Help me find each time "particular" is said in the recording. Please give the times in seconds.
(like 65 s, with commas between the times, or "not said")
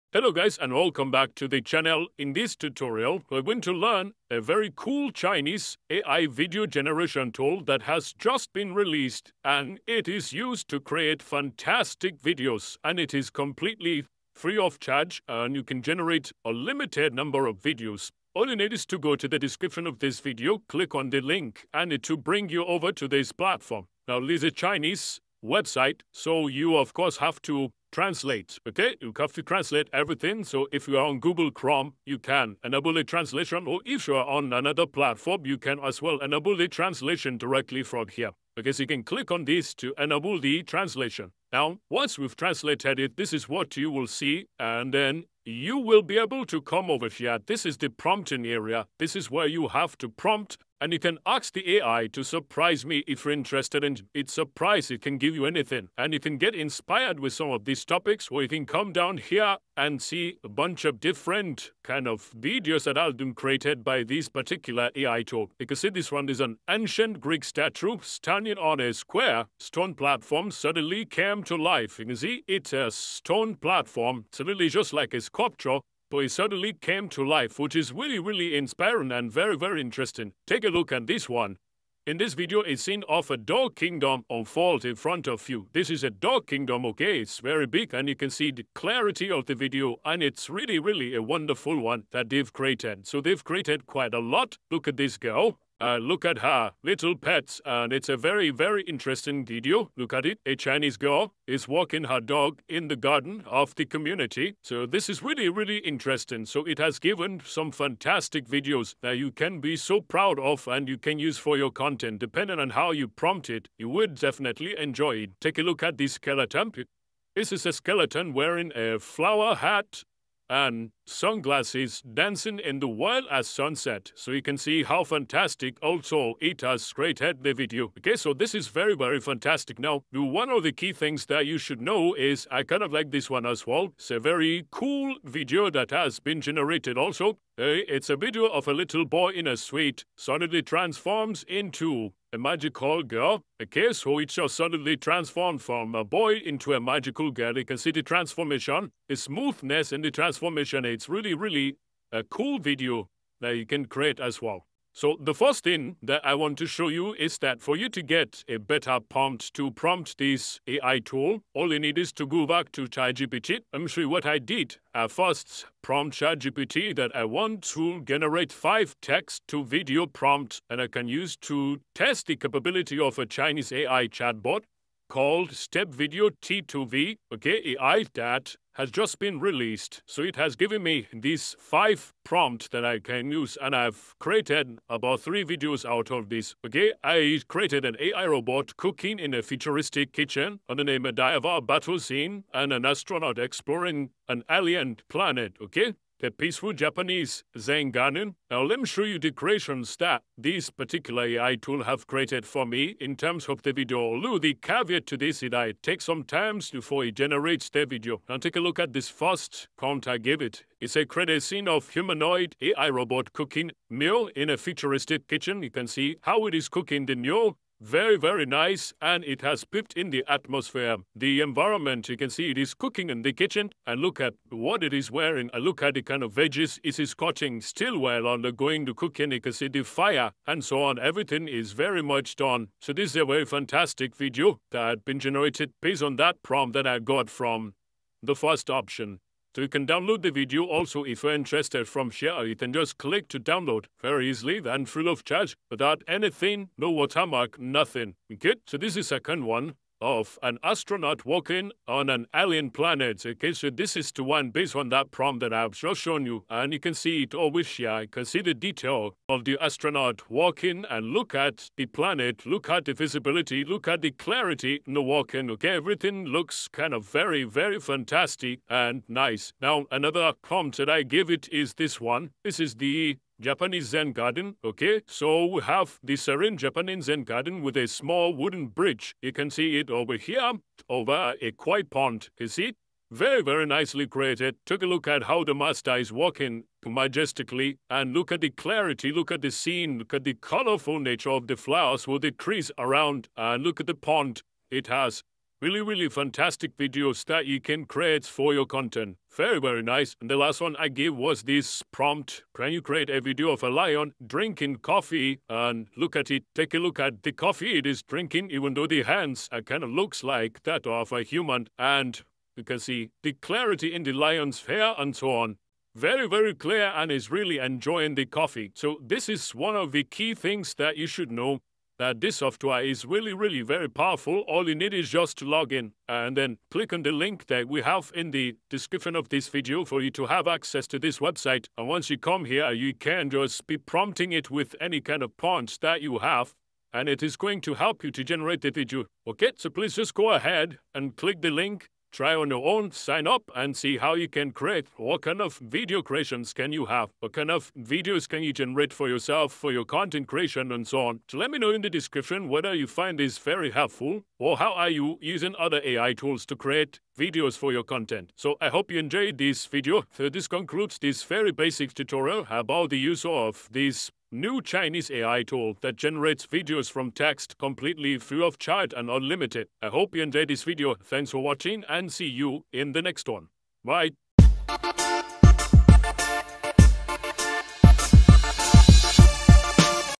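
64 s, 200 s.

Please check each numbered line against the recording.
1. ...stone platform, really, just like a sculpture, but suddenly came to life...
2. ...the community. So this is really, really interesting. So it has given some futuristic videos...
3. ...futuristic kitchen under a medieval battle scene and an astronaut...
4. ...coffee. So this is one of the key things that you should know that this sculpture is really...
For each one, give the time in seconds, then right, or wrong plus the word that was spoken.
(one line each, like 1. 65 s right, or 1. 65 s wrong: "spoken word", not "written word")
1. 72 s right
2. 103 s wrong: "fantastic", not "futuristic"
3. 189 s right
4. 318 s wrong: "software", not "sculpture".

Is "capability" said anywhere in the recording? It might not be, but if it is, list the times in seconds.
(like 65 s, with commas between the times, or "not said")
172 s.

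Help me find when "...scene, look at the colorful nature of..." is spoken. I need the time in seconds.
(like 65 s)
289 s.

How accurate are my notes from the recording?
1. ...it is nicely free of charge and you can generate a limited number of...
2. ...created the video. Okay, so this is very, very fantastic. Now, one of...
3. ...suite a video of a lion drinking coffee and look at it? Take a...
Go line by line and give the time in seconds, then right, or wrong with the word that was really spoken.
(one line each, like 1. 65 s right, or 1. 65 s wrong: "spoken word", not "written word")
1. 12 s wrong: "completely", not "nicely"
2. 126 s right
3. 302 s wrong: "create", not "suite".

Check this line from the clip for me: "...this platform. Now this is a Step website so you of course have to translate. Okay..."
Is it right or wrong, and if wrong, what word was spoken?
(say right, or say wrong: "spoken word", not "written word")
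wrong: "Chinese", not "Step".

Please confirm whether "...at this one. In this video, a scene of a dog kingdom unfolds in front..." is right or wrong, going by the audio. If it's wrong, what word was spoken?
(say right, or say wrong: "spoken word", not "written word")
right.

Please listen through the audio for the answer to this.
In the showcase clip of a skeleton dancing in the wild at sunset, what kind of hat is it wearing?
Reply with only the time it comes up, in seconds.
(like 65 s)
118 s.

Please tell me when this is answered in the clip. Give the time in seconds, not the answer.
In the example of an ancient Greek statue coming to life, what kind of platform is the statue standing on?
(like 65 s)
68 s.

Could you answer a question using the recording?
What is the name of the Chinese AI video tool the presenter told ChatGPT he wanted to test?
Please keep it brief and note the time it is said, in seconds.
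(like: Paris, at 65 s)
Step Video T2V, at 175 s.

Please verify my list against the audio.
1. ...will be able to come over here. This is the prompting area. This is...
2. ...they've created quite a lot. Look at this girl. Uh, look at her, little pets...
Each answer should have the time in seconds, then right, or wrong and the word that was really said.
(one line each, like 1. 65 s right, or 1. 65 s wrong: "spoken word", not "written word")
1. 45 s right
2. 93 s right.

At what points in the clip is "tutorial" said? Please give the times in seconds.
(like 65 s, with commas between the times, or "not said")
2 s, 361 s.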